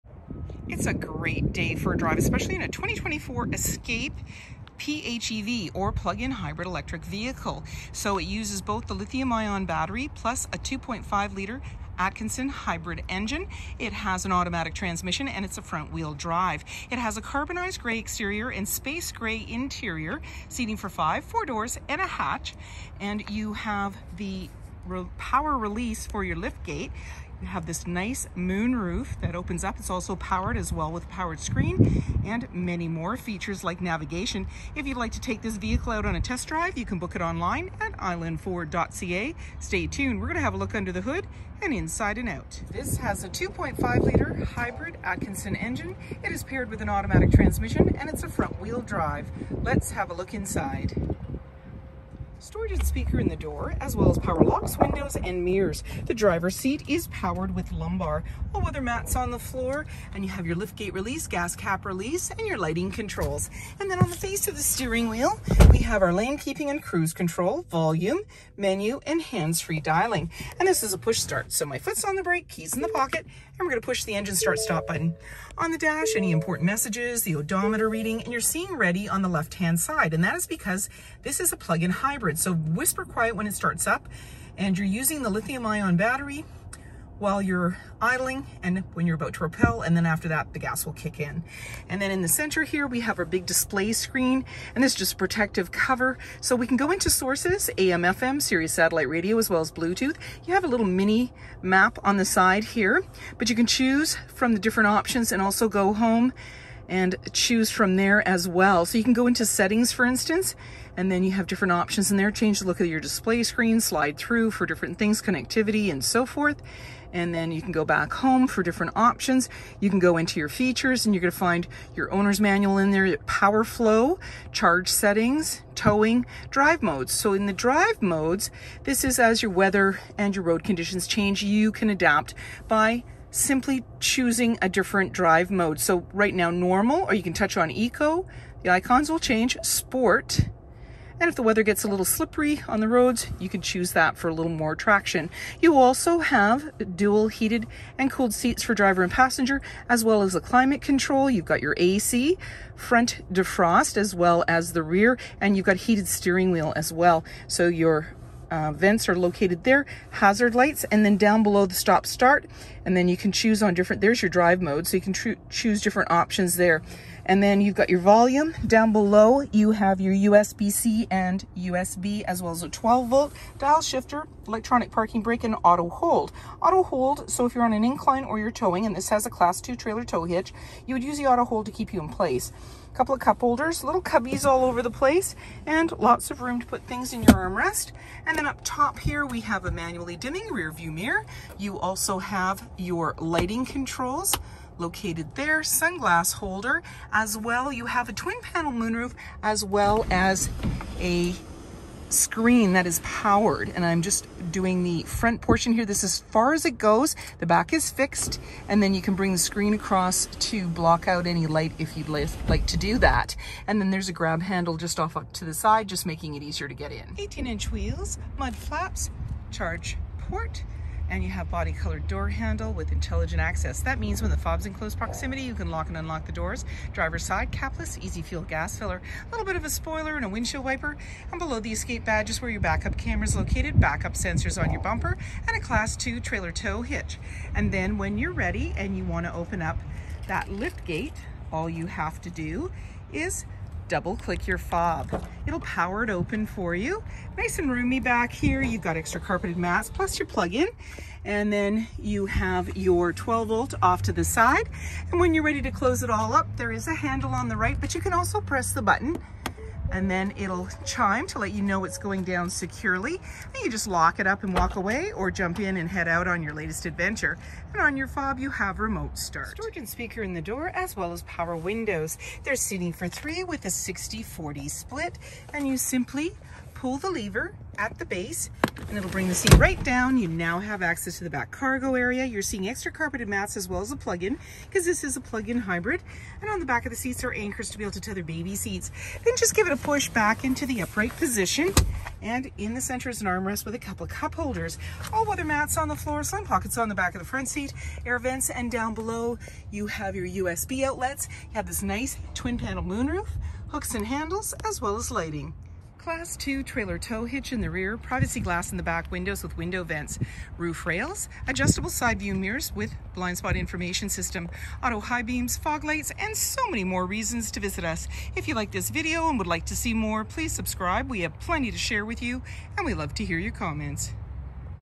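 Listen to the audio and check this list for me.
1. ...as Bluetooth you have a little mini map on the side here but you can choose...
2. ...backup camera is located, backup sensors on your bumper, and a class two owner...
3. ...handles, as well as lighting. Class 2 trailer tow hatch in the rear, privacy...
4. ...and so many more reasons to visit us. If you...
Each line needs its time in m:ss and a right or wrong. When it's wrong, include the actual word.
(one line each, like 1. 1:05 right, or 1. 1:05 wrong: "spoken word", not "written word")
1. 1:39 right
2. 3:52 wrong: "trailer", not "owner"
3. 5:04 wrong: "hitch", not "hatch"
4. 5:16 right.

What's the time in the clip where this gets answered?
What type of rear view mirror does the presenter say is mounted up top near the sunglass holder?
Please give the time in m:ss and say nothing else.
3:09.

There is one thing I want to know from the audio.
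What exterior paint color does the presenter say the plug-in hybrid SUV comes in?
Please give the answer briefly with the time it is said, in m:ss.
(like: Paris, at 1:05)
Carbonized gray, at 0:17.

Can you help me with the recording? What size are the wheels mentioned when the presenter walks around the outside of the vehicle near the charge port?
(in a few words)
18 inch.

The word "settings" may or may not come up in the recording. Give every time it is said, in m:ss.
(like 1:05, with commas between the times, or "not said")
1:49, 2:04.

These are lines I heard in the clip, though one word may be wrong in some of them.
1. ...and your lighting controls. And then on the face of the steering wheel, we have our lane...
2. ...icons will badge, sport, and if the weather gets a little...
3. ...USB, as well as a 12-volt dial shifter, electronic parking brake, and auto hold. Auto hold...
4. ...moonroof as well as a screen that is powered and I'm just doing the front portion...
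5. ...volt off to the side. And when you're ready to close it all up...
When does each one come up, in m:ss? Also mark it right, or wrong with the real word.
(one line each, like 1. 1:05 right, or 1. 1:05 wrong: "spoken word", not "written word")
1. 1:02 right
2. 2:18 wrong: "change", not "badge"
3. 2:51 right
4. 3:18 right
5. 4:13 right.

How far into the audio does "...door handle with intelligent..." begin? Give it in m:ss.
3:42.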